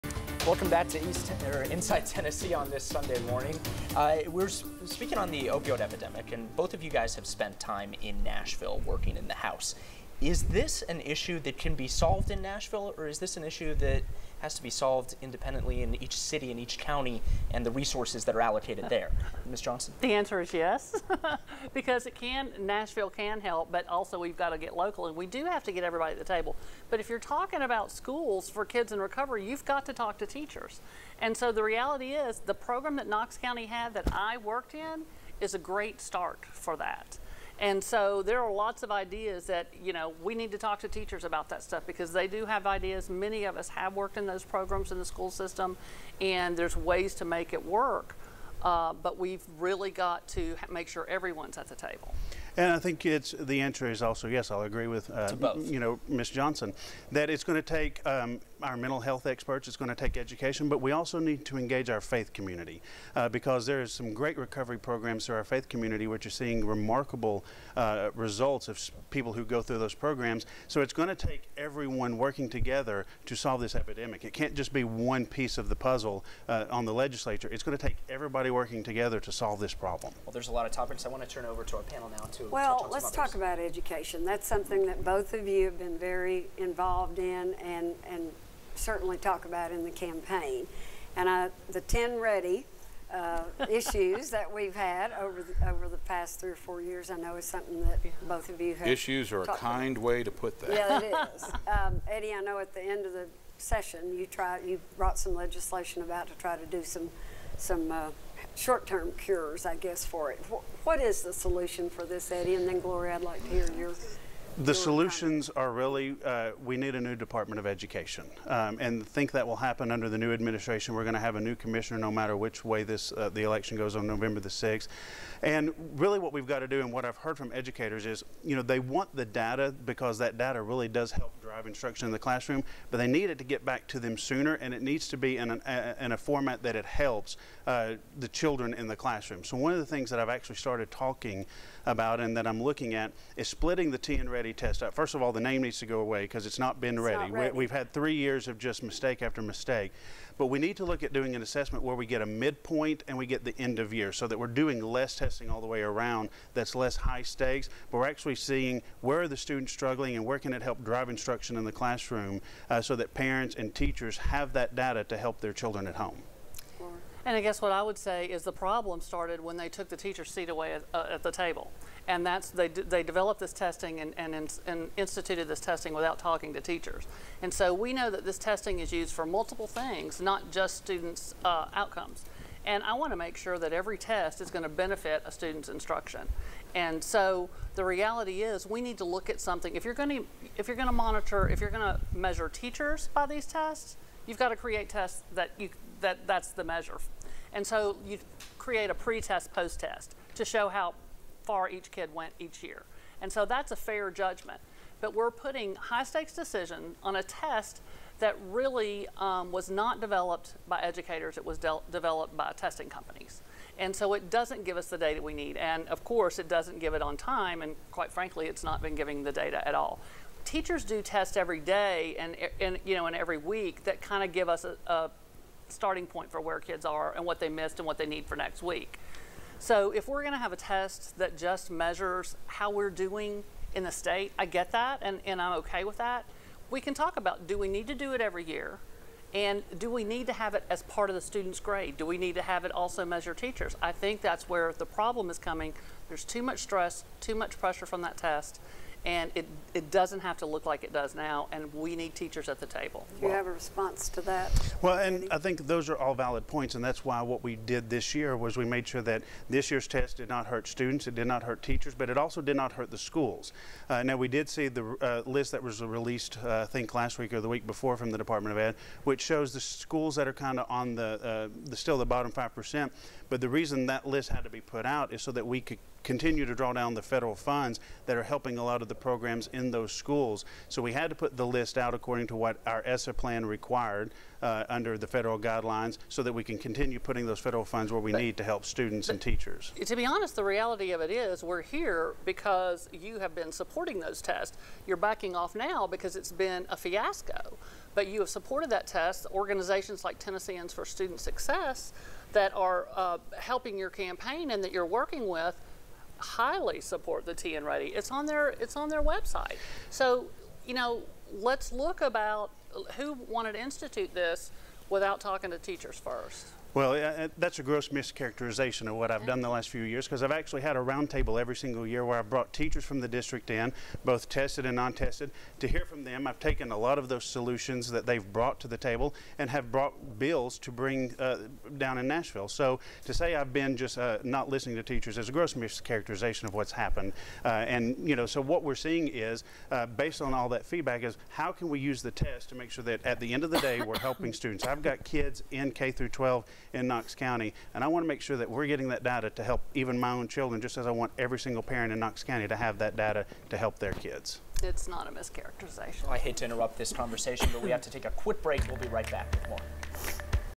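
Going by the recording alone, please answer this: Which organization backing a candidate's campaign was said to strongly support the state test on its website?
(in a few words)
Tennesseans for Student Success.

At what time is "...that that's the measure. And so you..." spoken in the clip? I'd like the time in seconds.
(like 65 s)
196 s.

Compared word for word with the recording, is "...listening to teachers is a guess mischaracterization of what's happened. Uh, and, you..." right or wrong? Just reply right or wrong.
wrong.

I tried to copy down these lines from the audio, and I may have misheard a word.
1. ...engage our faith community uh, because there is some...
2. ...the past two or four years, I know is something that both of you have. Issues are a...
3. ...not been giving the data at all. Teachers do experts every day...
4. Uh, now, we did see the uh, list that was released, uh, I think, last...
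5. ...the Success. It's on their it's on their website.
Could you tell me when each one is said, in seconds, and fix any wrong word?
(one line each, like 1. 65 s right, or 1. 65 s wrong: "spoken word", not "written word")
1. 61 s right
2. 95 s wrong: "three", not "two"
3. 218 s wrong: "tests", not "experts"
4. 263 s right
5. 307 s wrong: "TNReady", not "Success".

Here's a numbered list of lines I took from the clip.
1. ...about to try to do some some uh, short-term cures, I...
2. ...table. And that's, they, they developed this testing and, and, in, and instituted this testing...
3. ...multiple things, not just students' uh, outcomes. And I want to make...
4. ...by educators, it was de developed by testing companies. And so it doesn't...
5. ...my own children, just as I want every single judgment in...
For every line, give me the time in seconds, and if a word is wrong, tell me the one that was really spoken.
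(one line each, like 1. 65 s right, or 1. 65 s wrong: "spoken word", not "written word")
1. 106 s right
2. 171 s right
3. 179 s right
4. 210 s right
5. 349 s wrong: "parent", not "judgment".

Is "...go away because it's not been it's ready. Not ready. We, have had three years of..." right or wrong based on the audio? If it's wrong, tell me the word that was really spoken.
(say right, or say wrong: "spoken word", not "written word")
right.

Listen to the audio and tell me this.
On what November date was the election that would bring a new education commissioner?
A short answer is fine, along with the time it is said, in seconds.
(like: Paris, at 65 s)
November 6, at 124 s.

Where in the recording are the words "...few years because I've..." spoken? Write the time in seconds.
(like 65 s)
319 s.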